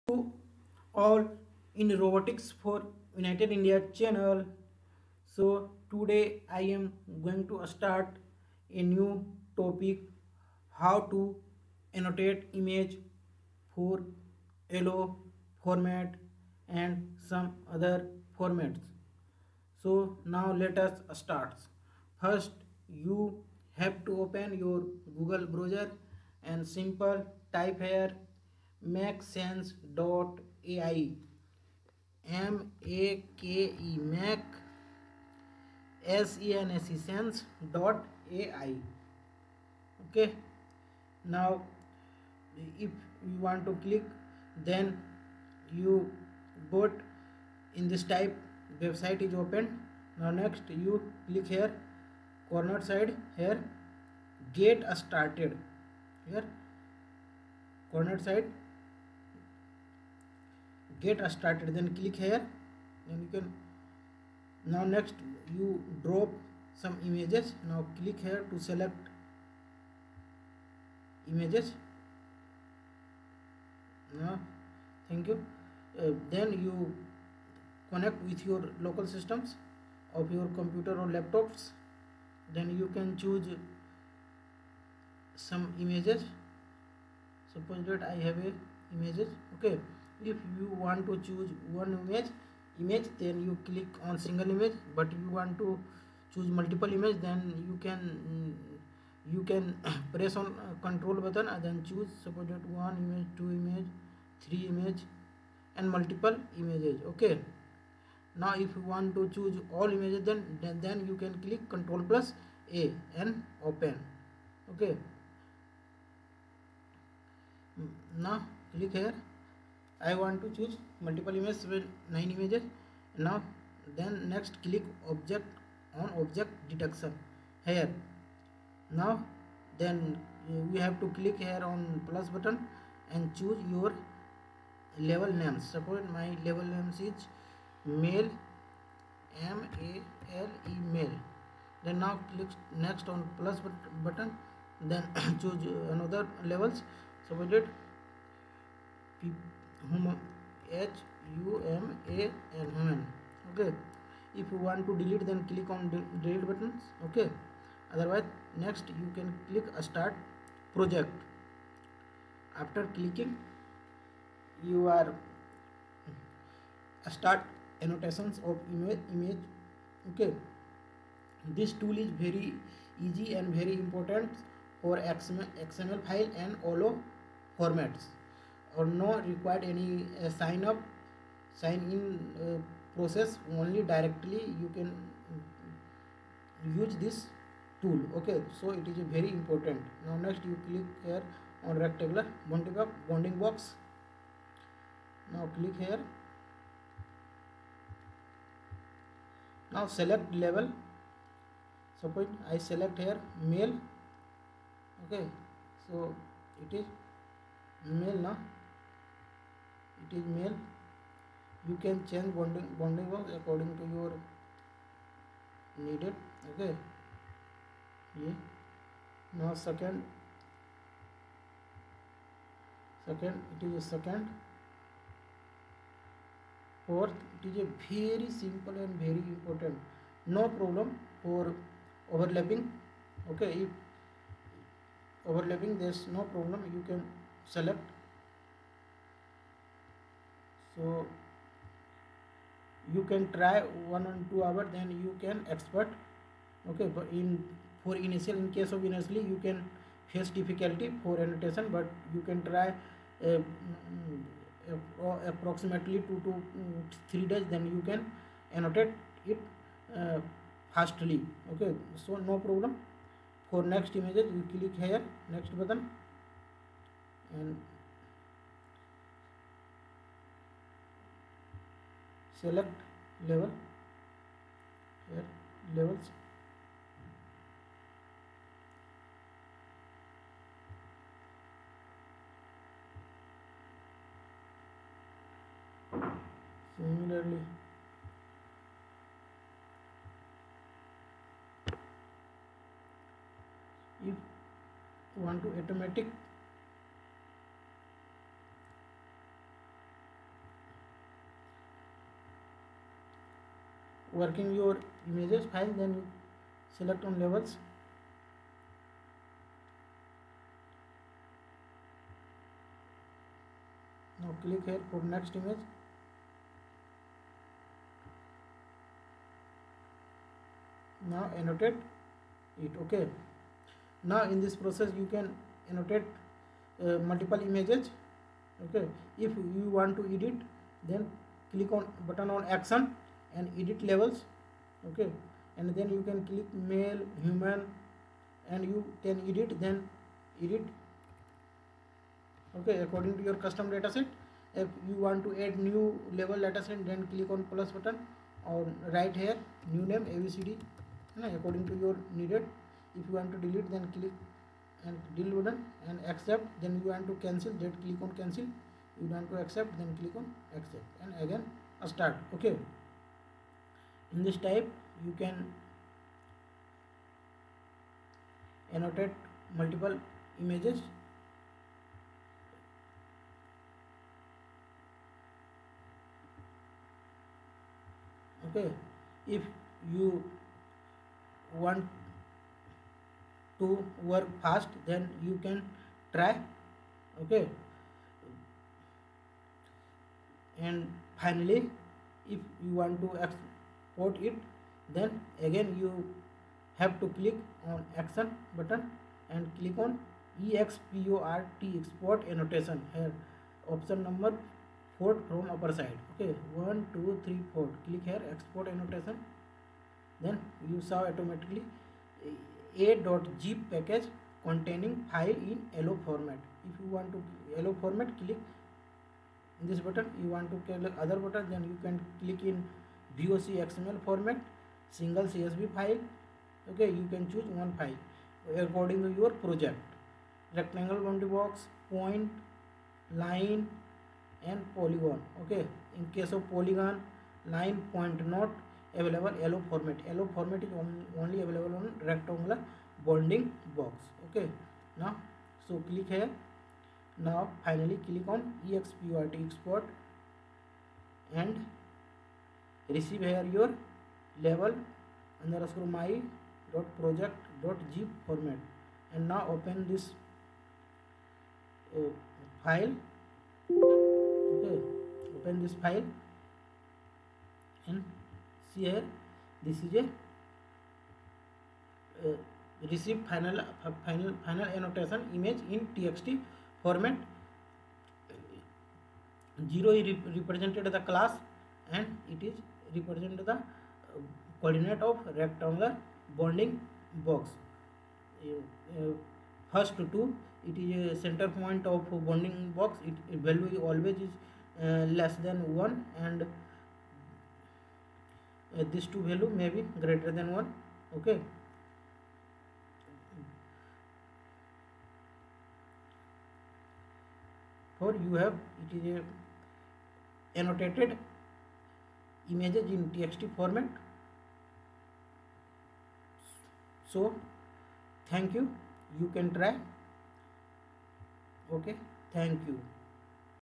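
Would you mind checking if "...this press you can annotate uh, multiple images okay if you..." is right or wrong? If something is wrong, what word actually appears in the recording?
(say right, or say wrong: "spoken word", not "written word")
wrong: "process", not "press".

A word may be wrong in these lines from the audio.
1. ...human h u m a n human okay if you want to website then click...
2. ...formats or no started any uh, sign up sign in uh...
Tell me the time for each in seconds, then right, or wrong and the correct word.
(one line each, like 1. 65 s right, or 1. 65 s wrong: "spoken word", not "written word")
1. 149 s wrong: "delete", not "website"
2. 177 s wrong: "required", not "started".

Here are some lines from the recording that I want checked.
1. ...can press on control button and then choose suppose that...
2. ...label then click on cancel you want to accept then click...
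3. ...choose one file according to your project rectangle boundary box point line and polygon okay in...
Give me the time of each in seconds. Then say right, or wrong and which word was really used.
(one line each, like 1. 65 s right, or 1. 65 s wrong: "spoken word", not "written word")
1. 99 s right
2. 357 s wrong: "cancel", not "label"
3. 427 s right.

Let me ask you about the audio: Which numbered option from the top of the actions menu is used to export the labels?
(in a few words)
4.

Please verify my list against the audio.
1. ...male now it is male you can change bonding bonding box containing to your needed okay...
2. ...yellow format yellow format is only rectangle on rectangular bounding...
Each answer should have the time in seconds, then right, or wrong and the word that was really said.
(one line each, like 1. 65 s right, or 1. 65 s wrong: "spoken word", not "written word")
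1. 207 s wrong: "according", not "containing"
2. 439 s wrong: "available", not "rectangle".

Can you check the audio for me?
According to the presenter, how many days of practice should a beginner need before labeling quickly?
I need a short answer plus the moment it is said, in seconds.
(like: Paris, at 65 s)
2 to 3 days, at 256 s.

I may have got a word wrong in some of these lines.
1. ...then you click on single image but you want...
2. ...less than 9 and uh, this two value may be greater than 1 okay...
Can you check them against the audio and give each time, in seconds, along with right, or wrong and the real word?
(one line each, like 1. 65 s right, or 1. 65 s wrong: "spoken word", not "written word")
1. 93 s right
2. 495 s wrong: "1", not "9".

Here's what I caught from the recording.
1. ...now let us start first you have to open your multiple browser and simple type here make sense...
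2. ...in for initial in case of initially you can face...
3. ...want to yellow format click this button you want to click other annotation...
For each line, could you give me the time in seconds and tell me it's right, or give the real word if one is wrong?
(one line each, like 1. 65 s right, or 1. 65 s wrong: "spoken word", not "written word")
1. 20 s wrong: "google", not "multiple"
2. 247 s right
3. 416 s wrong: "button", not "annotation".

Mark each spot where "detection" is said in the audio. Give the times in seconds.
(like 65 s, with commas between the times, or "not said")
126 s.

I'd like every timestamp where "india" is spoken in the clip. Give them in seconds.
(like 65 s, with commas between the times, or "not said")
3 s.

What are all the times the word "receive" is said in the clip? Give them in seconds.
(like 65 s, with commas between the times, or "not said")
452 s, 472 s.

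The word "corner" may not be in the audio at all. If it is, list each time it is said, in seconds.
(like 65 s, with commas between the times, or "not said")
52 s, 57 s.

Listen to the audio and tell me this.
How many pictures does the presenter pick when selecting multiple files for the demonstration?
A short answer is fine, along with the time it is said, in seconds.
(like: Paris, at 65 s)
9, at 122 s.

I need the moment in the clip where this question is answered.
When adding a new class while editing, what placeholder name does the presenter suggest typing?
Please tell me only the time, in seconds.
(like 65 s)
350 s.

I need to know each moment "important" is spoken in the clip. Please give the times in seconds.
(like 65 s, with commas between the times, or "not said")
173 s, 189 s, 229 s.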